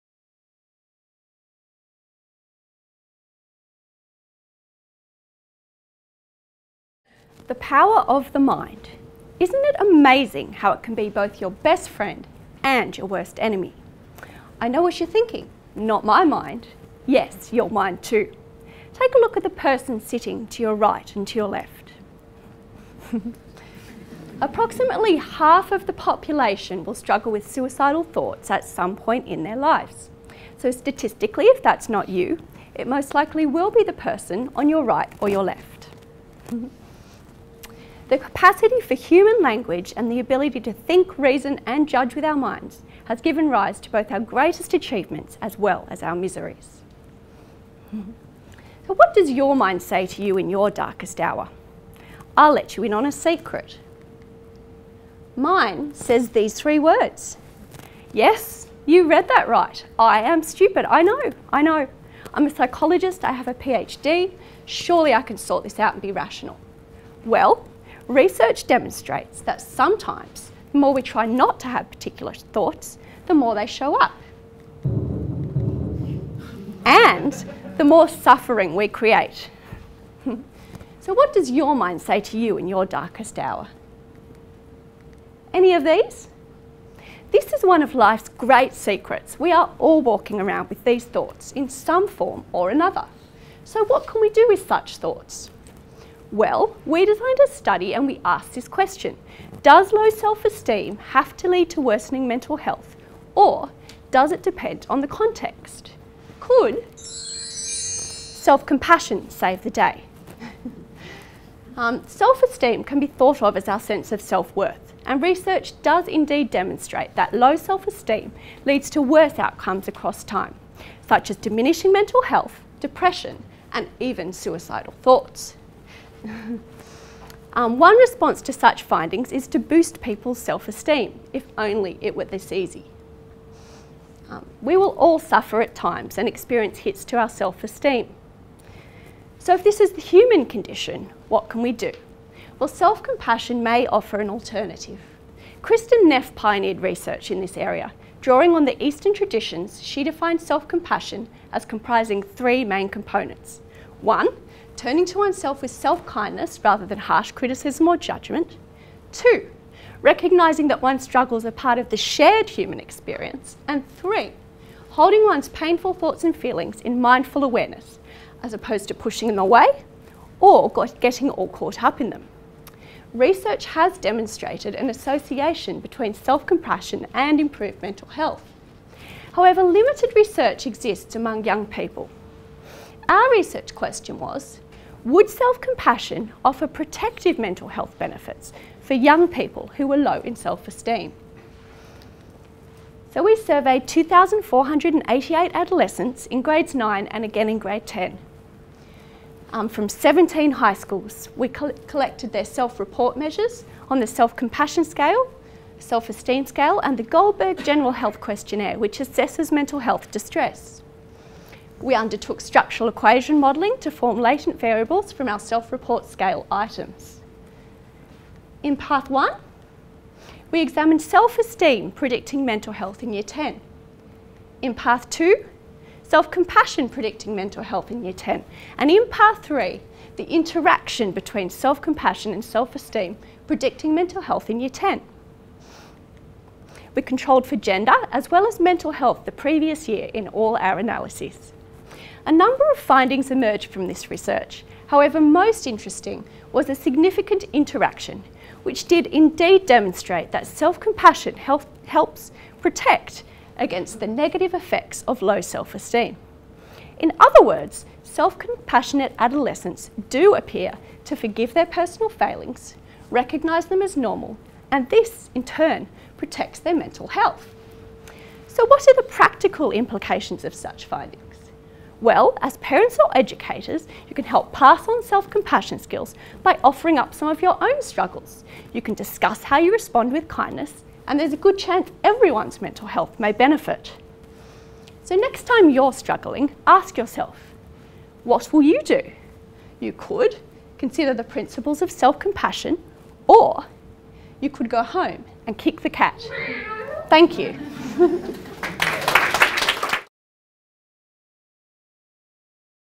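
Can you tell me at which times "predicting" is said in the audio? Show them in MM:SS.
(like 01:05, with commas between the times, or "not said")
03:41, 03:46, 03:53.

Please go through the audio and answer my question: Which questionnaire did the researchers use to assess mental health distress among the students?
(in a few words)
Goldberg General Health Questionnaire.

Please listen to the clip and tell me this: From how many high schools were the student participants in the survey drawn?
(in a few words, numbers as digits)
17.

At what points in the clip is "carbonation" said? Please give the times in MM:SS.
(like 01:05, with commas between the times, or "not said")
not said.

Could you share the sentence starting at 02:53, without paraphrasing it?
Research has demonstrated an association between self-compassion and improved mental health.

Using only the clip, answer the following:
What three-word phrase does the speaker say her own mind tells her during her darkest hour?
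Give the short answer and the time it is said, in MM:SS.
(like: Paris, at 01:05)
I am stupid, at 00:59.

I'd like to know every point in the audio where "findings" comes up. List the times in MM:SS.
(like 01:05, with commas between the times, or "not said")
02:08, 04:02, 04:30.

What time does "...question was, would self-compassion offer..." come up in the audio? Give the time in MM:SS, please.
03:03.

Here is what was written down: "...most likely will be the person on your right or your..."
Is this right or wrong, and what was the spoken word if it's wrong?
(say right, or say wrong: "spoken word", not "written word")
right.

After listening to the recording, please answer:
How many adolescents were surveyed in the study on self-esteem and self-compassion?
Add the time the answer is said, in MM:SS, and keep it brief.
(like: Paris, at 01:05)
2,488, at 03:13.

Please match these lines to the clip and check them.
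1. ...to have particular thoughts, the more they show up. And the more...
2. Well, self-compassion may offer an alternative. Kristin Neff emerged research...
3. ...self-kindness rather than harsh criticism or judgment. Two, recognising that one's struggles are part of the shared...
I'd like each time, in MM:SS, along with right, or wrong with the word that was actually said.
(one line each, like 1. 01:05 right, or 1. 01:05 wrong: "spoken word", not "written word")
1. 01:11 right
2. 02:22 wrong: "pioneered", not "emerged"
3. 02:35 right.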